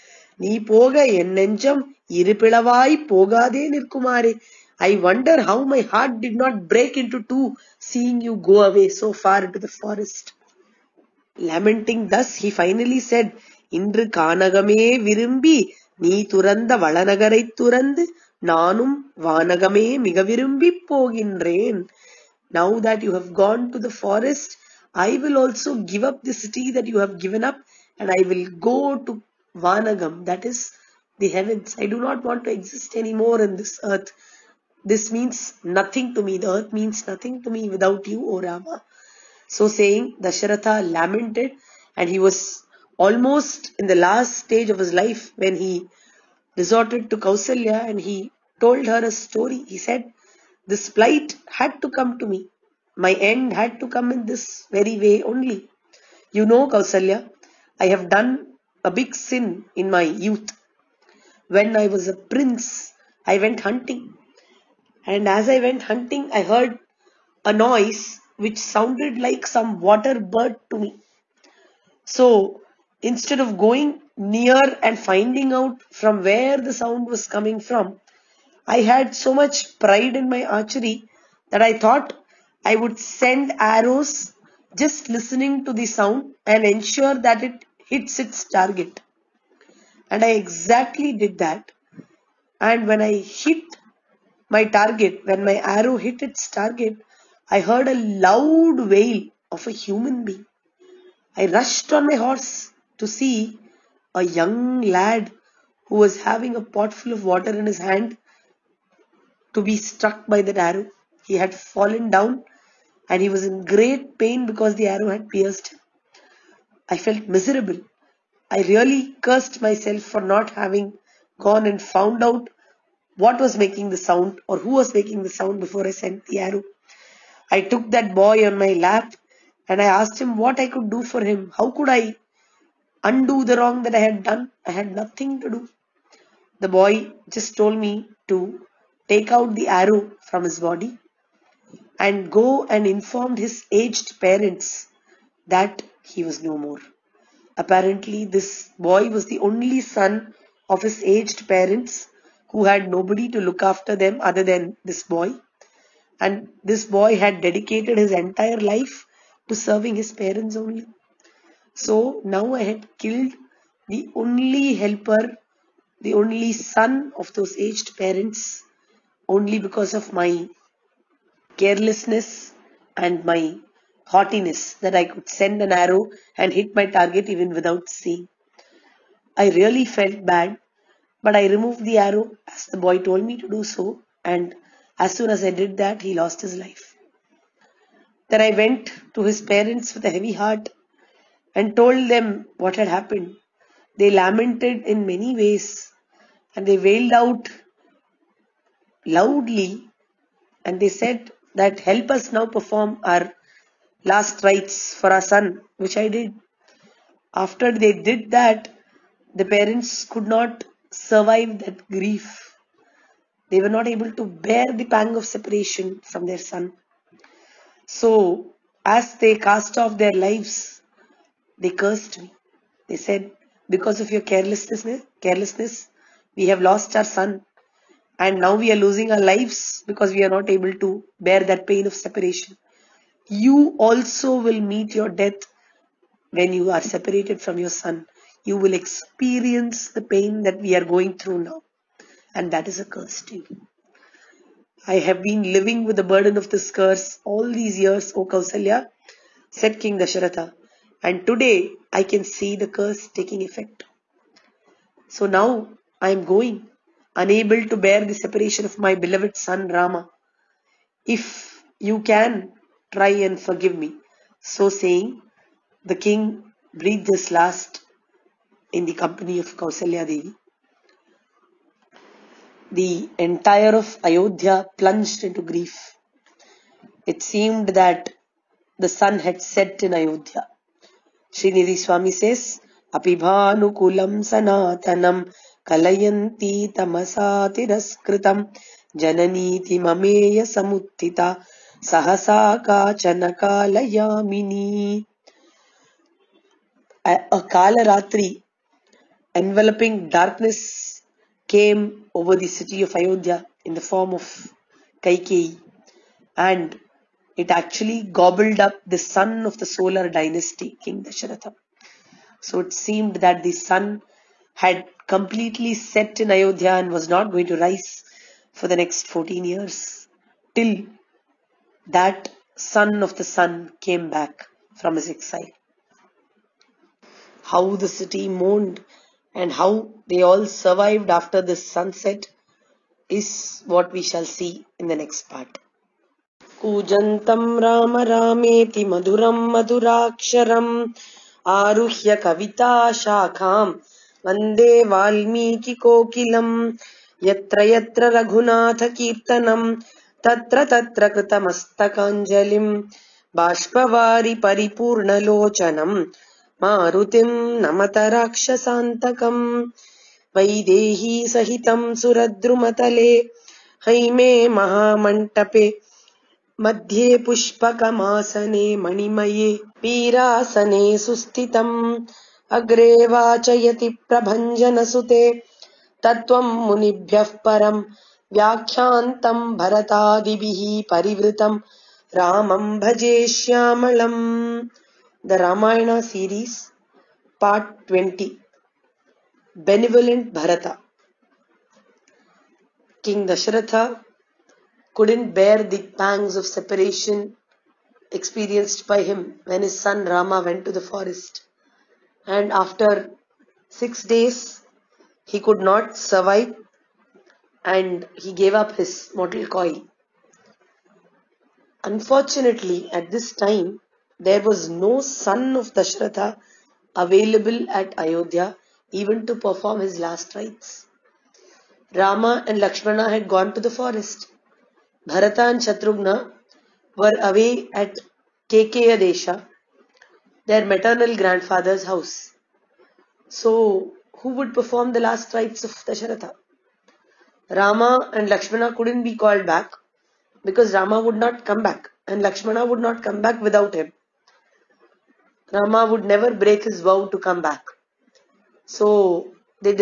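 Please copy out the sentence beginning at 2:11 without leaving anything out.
How could I undo the wrong that I had done?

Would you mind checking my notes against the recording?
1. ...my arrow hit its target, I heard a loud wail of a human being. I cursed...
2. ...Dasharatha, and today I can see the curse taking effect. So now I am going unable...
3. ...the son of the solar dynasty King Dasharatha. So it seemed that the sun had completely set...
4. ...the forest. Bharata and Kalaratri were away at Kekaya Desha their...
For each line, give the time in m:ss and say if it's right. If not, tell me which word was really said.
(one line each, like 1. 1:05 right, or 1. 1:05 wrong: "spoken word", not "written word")
1. 1:35 wrong: "rushed", not "cursed"
2. 4:09 right
3. 5:08 right
4. 7:03 wrong: "Shatrughna", not "Kalaratri".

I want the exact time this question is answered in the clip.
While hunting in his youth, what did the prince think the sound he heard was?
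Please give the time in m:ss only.
1:09.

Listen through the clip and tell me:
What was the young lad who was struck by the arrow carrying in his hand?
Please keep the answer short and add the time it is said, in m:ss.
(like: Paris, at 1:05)
A pot full of water, at 1:46.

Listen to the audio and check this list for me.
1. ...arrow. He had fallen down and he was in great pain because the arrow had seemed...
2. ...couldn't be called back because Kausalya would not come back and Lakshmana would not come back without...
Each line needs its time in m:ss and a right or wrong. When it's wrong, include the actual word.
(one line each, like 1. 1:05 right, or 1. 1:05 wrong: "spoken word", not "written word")
1. 1:50 wrong: "pierced", not "seemed"
2. 7:18 wrong: "Rama", not "Kausalya".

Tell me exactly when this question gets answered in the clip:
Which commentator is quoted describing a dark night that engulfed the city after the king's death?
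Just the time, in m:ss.
4:41.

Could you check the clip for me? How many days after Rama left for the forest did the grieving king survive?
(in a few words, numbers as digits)
6.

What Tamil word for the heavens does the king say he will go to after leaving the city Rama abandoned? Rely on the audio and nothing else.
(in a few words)
Vanagam.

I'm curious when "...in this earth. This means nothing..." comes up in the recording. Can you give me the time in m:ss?
0:33.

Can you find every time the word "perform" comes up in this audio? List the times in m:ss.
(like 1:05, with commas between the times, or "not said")
3:22, 6:59, 7:14.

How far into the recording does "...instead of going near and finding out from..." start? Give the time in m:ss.
1:12.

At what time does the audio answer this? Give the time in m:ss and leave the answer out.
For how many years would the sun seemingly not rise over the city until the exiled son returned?
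5:19.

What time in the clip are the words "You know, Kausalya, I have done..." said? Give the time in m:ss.
0:56.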